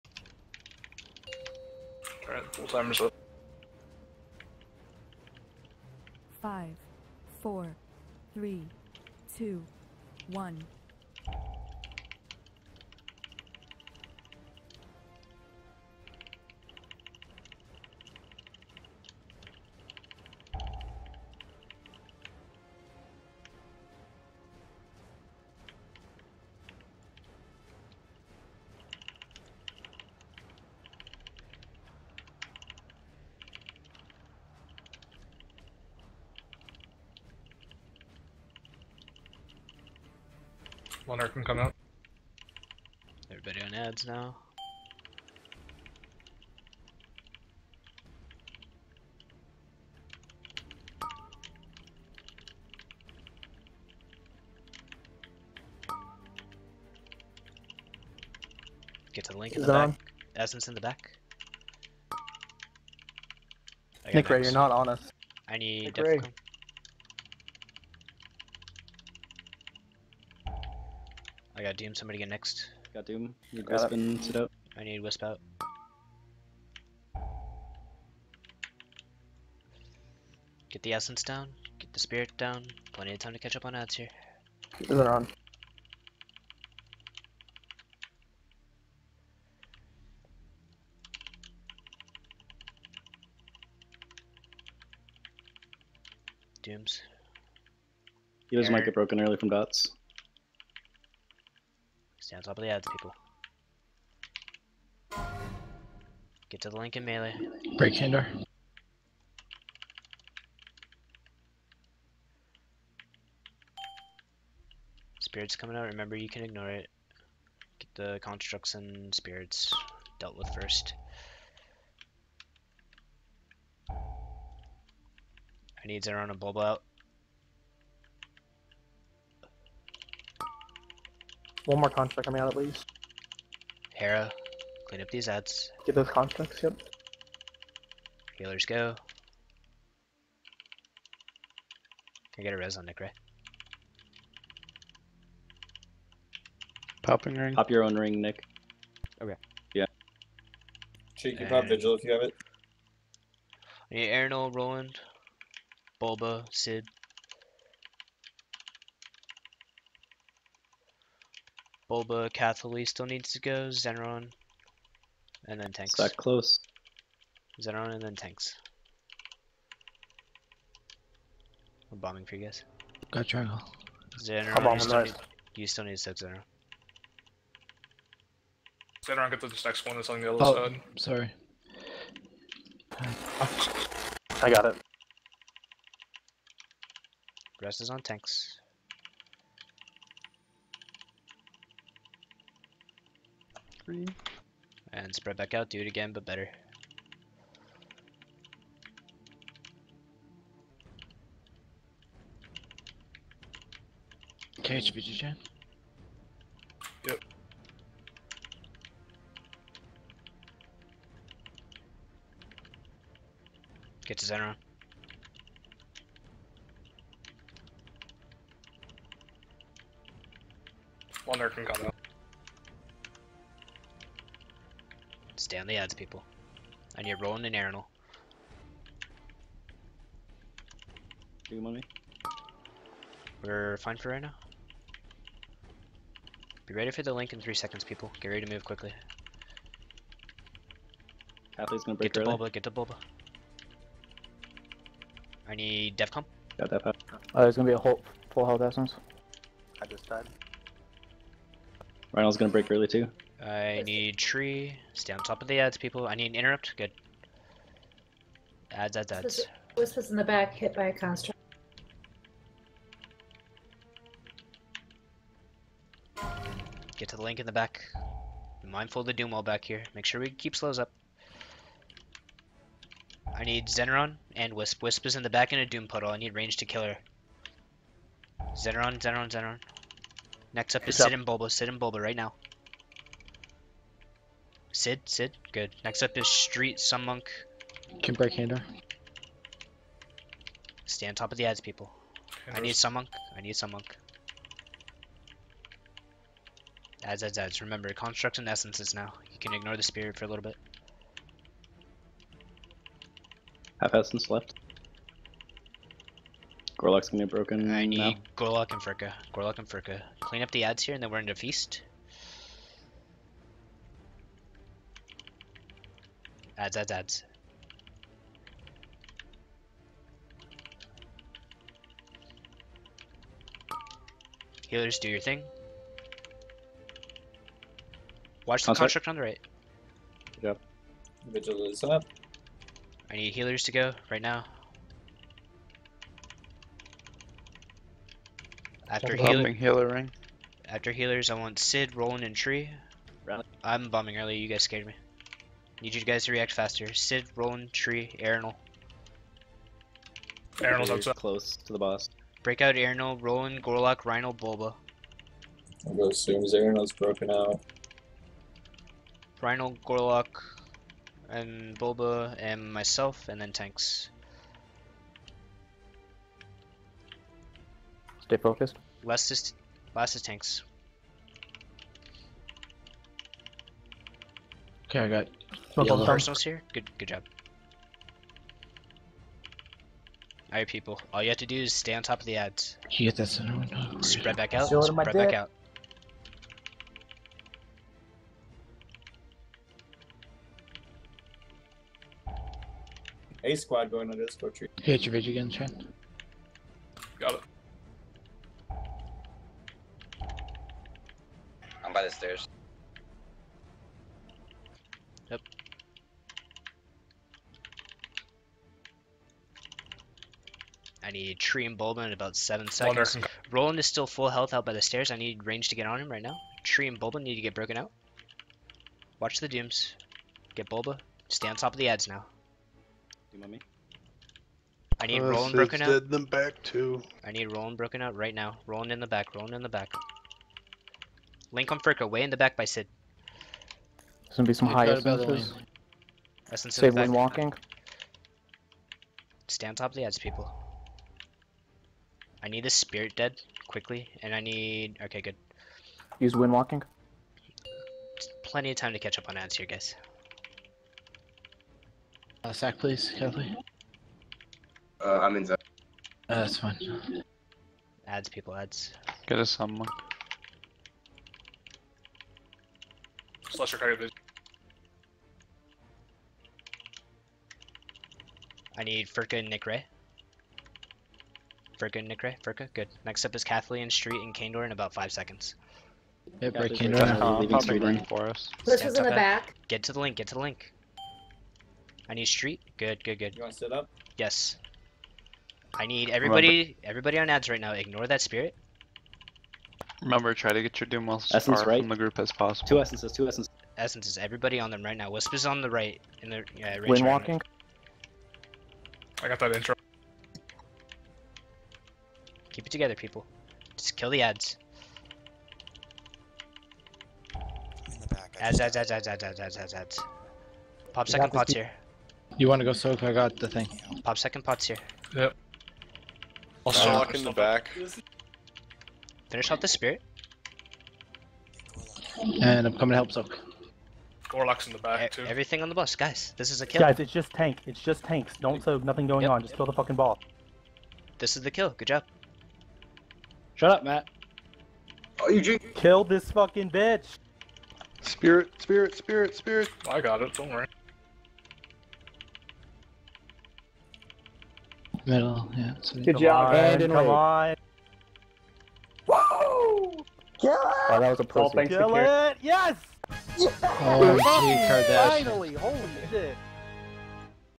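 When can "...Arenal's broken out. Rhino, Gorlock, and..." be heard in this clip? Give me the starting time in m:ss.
5:56.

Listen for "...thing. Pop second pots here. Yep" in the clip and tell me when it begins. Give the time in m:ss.
8:33.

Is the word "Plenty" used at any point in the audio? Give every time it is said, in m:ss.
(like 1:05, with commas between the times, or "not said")
1:22, 7:28.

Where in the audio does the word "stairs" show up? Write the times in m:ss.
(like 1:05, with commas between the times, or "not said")
6:42, 6:54.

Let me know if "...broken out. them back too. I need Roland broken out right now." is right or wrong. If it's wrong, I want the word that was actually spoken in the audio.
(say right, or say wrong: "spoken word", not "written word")
right.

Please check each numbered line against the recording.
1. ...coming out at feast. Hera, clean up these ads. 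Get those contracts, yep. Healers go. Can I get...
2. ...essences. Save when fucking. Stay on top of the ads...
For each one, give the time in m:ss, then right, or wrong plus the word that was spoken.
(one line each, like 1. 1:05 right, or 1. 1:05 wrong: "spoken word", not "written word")
1. 2:12 wrong: "least", not "feast"
2. 7:14 wrong: "walking", not "fucking".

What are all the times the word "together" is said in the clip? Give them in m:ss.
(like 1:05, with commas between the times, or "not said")
8:22.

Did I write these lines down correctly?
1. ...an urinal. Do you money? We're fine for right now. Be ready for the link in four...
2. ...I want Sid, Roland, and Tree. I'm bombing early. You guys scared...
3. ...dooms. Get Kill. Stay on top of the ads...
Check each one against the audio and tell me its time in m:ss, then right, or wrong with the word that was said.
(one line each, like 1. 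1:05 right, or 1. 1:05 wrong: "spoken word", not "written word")
1. 3:47 wrong: "three", not "four"
2. 5:41 right
3. 6:59 wrong: "Bulba", not "Kill".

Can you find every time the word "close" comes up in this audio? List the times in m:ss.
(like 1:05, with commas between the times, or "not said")
2:46, 5:51.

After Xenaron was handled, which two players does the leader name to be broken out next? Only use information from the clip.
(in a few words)
Sit and Bulba.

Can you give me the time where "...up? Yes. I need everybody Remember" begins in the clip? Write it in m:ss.
8:03.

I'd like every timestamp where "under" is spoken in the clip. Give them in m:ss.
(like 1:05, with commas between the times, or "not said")
6:34.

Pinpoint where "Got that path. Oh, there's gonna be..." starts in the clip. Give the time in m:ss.
4:06.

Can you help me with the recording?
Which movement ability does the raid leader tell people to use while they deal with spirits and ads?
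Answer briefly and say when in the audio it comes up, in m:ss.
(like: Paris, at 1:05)
Wind walking, at 7:26.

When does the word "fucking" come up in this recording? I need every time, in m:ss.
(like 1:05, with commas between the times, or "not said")
8:49, 8:56.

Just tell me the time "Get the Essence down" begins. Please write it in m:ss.
1:20.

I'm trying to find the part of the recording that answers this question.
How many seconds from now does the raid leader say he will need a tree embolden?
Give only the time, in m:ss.
6:52.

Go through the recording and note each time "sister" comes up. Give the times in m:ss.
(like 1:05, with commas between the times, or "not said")
not said.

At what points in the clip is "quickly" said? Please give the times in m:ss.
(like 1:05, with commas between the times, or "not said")
3:58, 7:23.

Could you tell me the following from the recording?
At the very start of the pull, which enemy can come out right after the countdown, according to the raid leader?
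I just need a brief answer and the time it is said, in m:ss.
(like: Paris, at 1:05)
Monarch, at 0:41.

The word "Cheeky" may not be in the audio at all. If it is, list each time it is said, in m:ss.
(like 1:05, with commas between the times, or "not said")
2:31.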